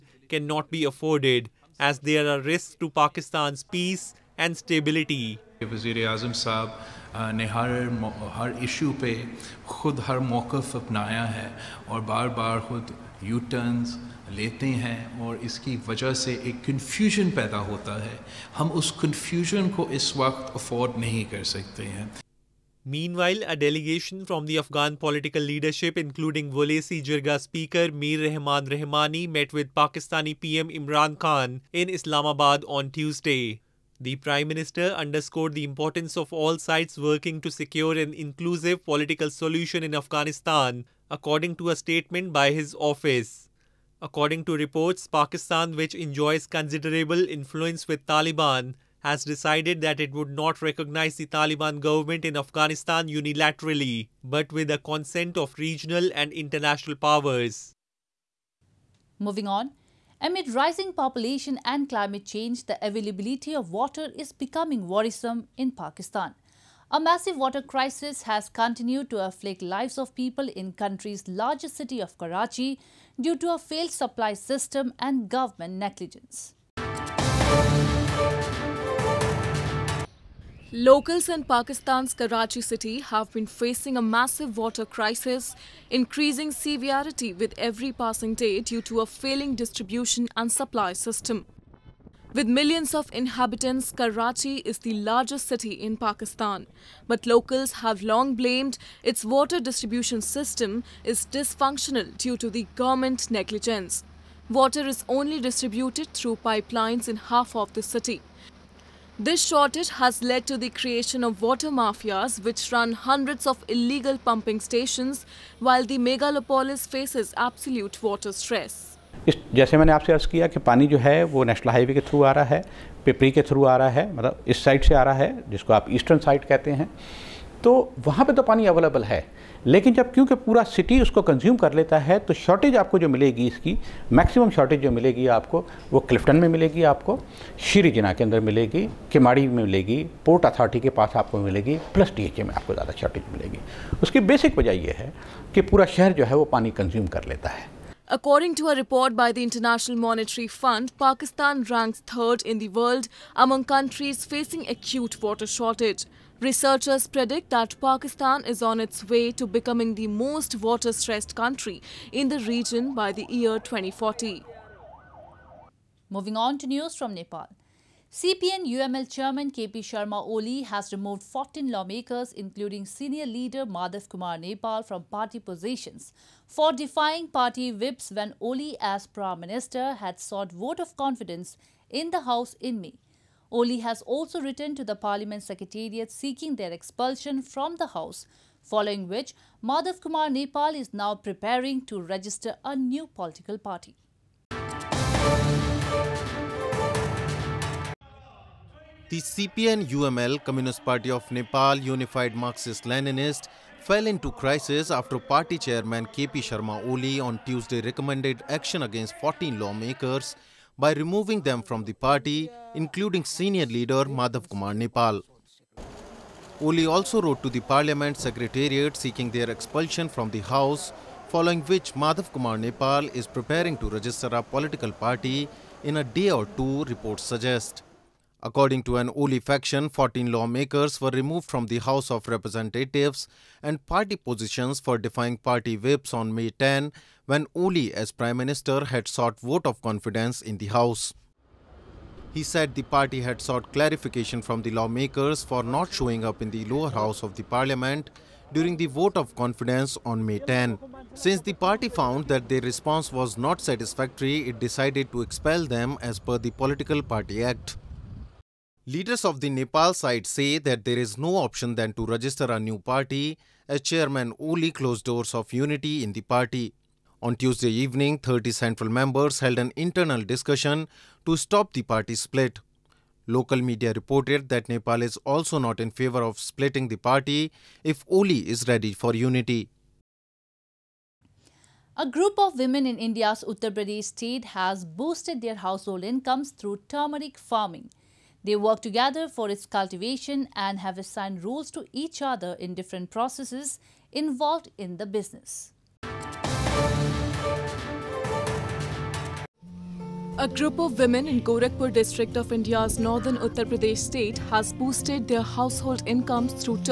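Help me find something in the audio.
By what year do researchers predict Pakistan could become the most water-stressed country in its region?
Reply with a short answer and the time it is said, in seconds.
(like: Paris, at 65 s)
2040, at 163 s.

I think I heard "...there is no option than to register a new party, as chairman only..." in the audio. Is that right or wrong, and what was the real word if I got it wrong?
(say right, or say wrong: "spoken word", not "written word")
right.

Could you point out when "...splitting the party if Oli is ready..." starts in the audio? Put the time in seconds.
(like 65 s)
276 s.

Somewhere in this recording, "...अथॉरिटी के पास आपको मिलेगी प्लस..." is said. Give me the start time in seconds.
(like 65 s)
140 s.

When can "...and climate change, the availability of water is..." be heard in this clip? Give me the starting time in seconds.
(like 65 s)
61 s.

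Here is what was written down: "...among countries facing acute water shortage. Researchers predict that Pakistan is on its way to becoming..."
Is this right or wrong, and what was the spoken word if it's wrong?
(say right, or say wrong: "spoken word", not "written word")
right.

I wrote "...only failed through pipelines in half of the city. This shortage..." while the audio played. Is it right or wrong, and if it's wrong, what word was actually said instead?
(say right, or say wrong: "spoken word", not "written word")
wrong: "distributed", not "failed".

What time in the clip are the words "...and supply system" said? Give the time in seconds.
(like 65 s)
90 s.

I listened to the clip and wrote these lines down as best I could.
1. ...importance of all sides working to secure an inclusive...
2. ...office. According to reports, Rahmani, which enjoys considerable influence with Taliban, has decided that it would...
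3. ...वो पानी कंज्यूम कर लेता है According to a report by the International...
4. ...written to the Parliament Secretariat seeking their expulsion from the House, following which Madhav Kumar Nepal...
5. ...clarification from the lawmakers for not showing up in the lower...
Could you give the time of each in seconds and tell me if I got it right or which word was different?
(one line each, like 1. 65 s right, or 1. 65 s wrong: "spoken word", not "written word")
1. 35 s right
2. 42 s wrong: "Pakistan", not "Rahmani"
3. 146 s right
4. 184 s right
5. 243 s right.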